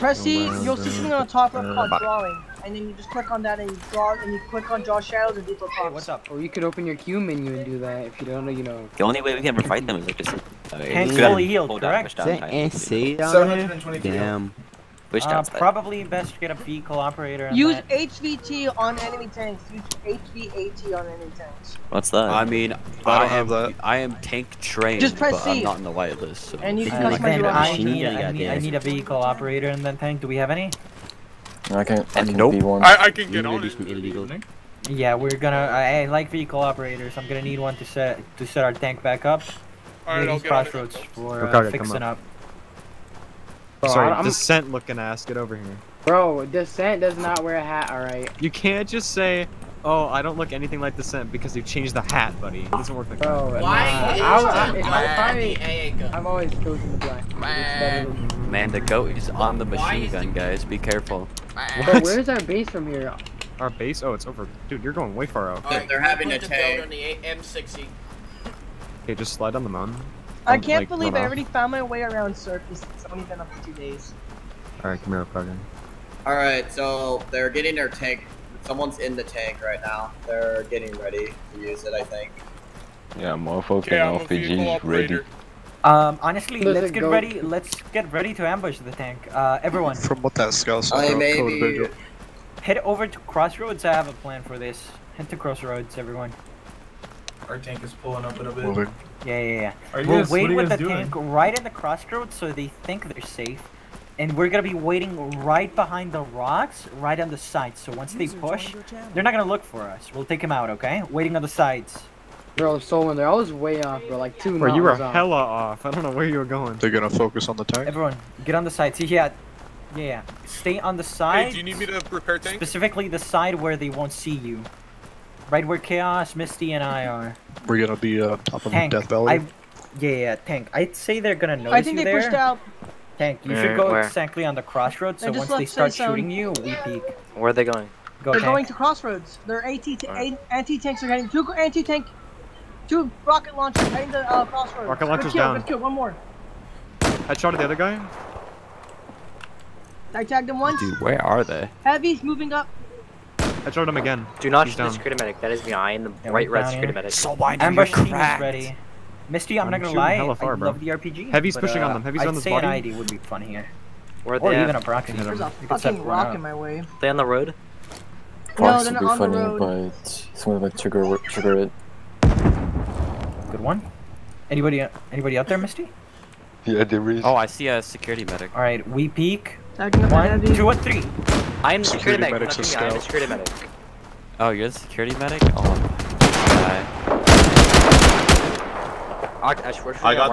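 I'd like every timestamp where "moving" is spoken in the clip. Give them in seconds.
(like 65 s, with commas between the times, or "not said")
98 s, 152 s.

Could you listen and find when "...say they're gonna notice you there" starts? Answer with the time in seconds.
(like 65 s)
130 s.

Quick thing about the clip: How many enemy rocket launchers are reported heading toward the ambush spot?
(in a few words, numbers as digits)
2.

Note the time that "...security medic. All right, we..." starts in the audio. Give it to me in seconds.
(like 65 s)
177 s.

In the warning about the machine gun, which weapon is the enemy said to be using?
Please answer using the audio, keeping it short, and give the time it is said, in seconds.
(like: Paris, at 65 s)
M60, at 67 s.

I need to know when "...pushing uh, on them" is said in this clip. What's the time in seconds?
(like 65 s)
161 s.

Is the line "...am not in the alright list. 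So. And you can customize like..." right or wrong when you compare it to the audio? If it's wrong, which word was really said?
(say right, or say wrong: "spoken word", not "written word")
wrong: "light", not "alright".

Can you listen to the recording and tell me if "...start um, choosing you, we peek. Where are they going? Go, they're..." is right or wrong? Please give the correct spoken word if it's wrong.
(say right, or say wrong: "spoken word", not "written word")
wrong: "shooting", not "choosing".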